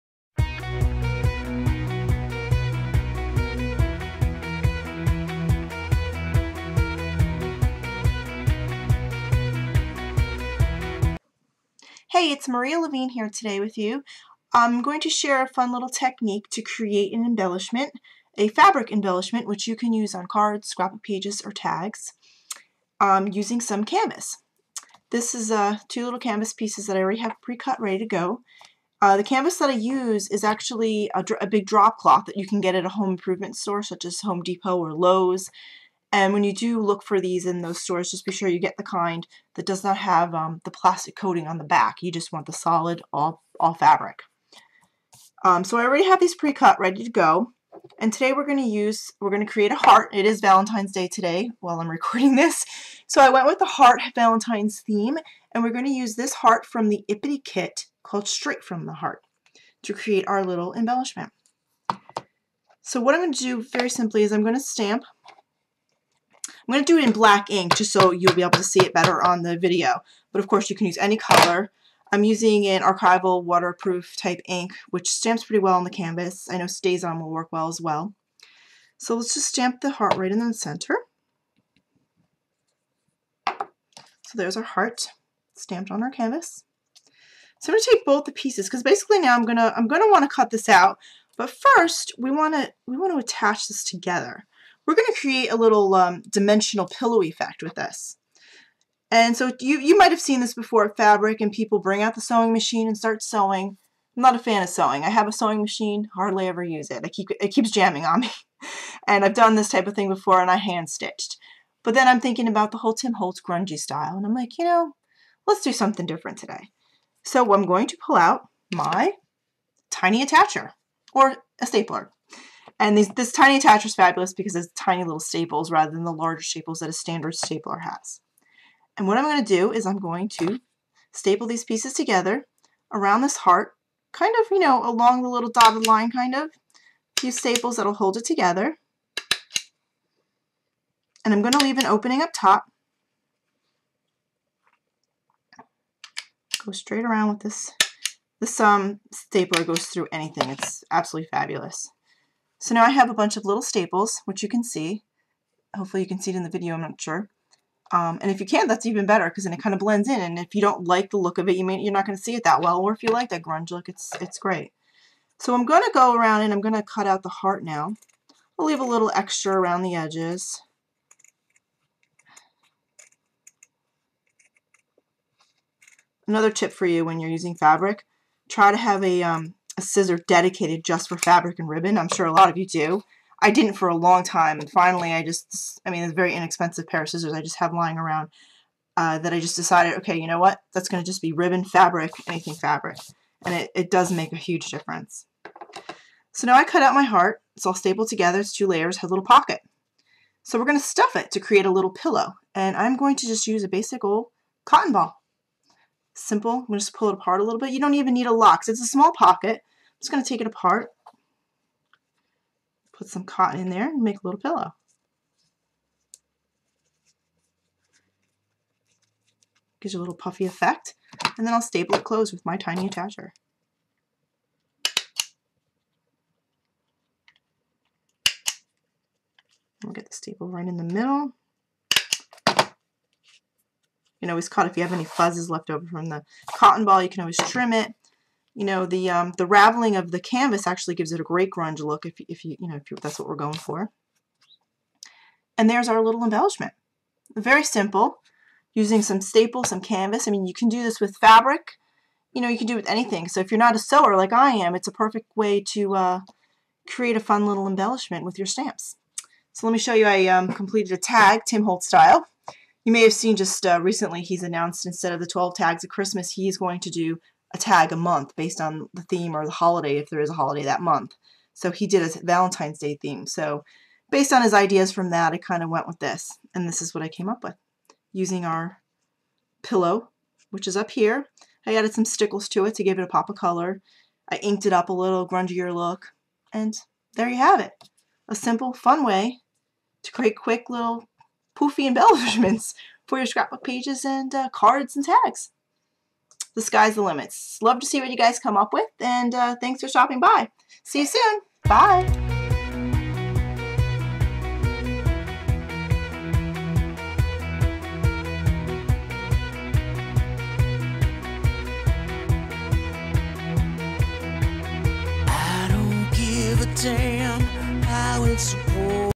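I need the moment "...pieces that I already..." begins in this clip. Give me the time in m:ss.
0:26.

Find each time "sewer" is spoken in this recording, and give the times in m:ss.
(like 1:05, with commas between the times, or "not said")
4:13.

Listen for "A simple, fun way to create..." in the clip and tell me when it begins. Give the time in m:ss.
4:48.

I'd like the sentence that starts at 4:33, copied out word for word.
So based on his ideas from that, I kind of went with this.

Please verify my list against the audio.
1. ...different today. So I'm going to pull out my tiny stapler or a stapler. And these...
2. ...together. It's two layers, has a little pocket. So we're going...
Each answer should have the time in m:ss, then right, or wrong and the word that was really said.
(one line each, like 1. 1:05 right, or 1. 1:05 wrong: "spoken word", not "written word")
1. 1:56 wrong: "attacher", not "stapler"
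2. 3:18 right.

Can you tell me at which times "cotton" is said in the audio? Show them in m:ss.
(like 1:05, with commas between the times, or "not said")
3:24, 3:33, 3:56.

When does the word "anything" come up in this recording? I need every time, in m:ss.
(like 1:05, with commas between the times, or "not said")
2:30, 3:12, 4:12.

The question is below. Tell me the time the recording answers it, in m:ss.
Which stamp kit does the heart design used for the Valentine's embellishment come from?
0:58.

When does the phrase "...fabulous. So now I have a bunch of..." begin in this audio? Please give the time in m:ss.
2:31.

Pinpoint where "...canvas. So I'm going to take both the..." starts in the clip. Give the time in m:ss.
1:26.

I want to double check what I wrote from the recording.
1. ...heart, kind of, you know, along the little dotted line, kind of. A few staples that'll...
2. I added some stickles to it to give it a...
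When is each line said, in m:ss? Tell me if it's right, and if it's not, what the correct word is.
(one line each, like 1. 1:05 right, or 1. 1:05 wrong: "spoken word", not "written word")
1. 2:13 right
2. 4:41 right.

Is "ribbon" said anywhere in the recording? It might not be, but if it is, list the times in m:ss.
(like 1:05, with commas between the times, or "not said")
3:01, 3:11.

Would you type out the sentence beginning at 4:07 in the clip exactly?
Very simple, using some staple, some canvas.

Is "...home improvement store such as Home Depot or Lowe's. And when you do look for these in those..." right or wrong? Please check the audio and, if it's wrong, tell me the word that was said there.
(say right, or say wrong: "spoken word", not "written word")
right.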